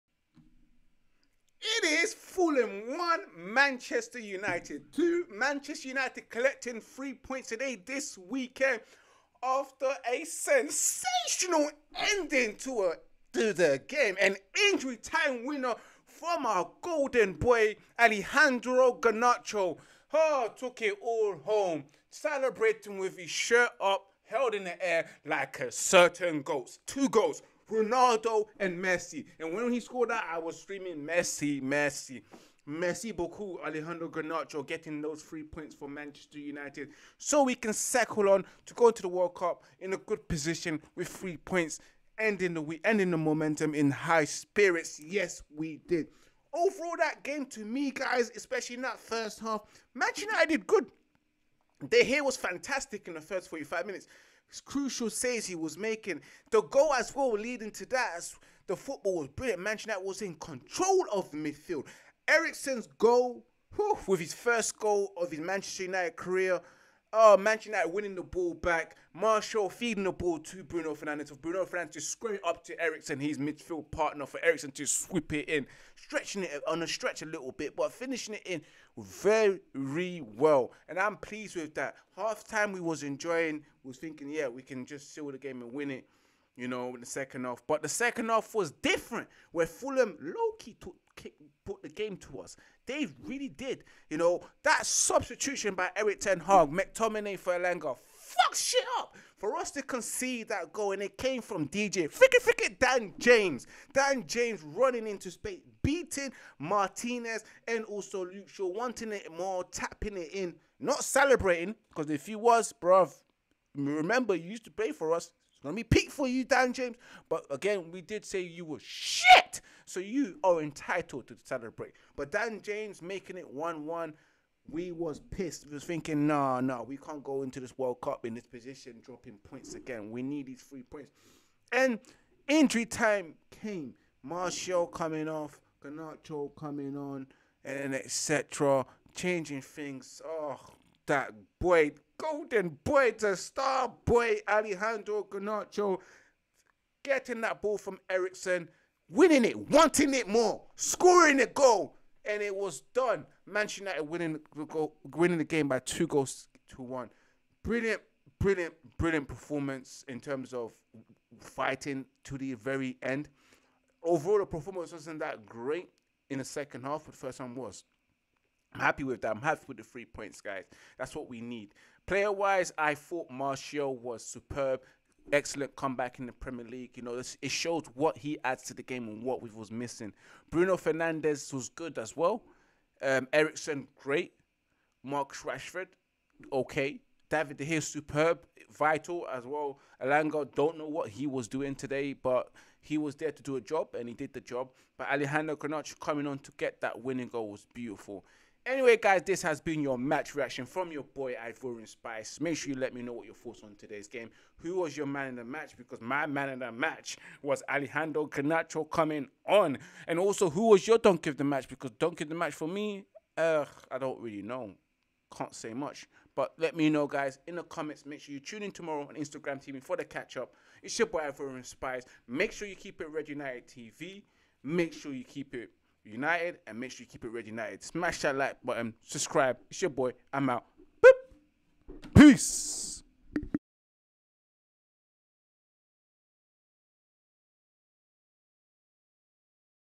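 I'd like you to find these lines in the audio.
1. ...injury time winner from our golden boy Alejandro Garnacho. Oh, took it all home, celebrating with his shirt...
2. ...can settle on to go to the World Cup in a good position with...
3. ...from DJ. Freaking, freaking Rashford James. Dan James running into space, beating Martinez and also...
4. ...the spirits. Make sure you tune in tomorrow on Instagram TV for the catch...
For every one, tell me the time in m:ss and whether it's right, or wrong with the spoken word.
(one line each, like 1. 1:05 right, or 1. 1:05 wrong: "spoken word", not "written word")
1. 0:14 right
2. 0:37 right
3. 1:41 wrong: "Dan", not "Rashford"
4. 3:37 wrong: "comments", not "spirits".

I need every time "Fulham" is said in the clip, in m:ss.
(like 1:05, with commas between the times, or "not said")
0:02, 1:29.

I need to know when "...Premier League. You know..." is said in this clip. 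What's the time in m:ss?
2:56.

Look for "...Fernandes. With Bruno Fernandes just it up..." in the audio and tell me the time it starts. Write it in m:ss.
1:10.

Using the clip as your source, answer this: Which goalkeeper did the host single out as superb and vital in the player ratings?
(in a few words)
David De Gea.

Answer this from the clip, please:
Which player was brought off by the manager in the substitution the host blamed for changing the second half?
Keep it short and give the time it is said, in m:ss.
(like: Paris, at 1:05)
McTominay, at 1:36.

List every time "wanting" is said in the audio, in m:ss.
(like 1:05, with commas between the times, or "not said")
1:48, 2:29.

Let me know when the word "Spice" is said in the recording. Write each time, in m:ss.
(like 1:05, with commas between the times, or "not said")
3:21, 3:41.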